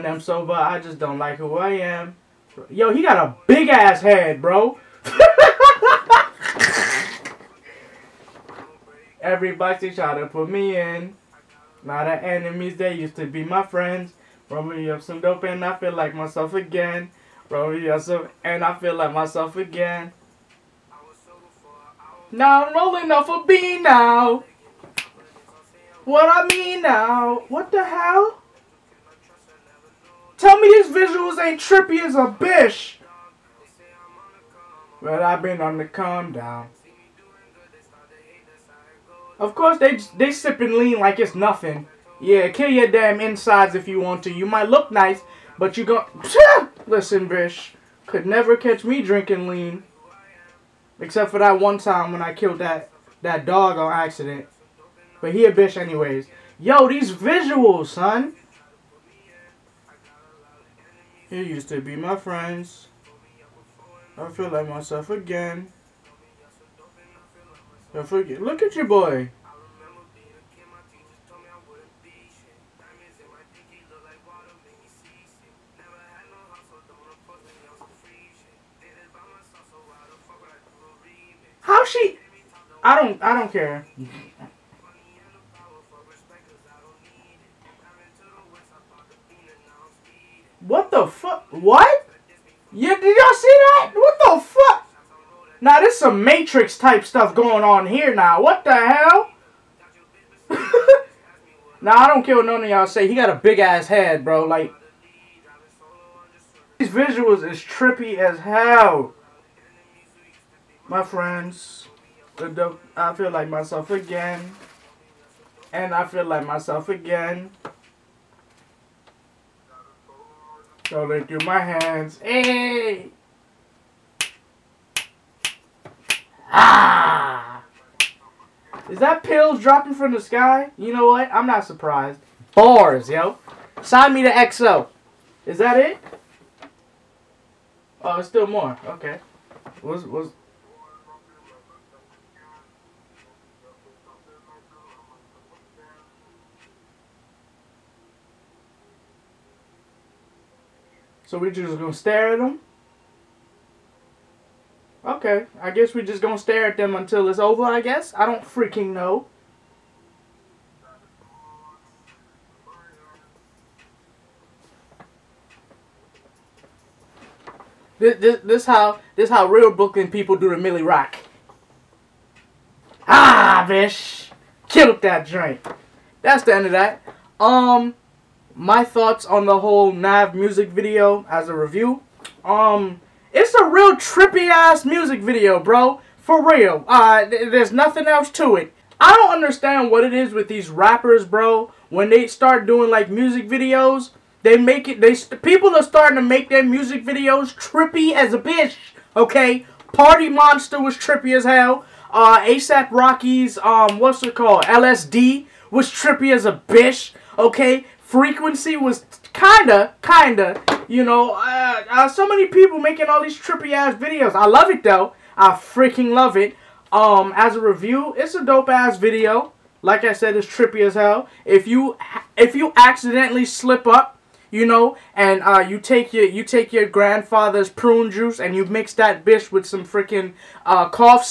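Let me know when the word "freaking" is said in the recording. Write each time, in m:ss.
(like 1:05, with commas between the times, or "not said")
2:38, 3:35, 3:49.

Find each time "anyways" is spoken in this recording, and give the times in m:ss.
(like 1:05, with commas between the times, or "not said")
0:55.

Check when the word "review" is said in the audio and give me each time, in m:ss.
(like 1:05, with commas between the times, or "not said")
3:01, 3:37.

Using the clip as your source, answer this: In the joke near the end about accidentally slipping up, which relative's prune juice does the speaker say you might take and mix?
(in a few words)
grandfather's.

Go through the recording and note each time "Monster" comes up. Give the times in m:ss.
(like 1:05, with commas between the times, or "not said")
3:20.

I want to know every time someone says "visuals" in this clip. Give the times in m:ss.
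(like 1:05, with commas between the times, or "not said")
0:30, 0:57, 1:46.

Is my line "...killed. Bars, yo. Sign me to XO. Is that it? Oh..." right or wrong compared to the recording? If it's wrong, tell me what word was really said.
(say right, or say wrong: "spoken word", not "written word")
wrong: "surprised", not "killed".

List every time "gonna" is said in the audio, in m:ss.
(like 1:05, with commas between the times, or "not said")
2:31, 2:36.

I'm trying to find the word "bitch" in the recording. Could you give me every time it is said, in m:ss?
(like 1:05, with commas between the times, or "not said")
0:32, 0:47, 0:55, 2:53, 3:18, 3:26, 3:49.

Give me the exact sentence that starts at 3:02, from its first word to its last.
Um, it's a real trippy ass music video, bro.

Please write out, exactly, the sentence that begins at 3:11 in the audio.
When they start doing like music videos, they make it.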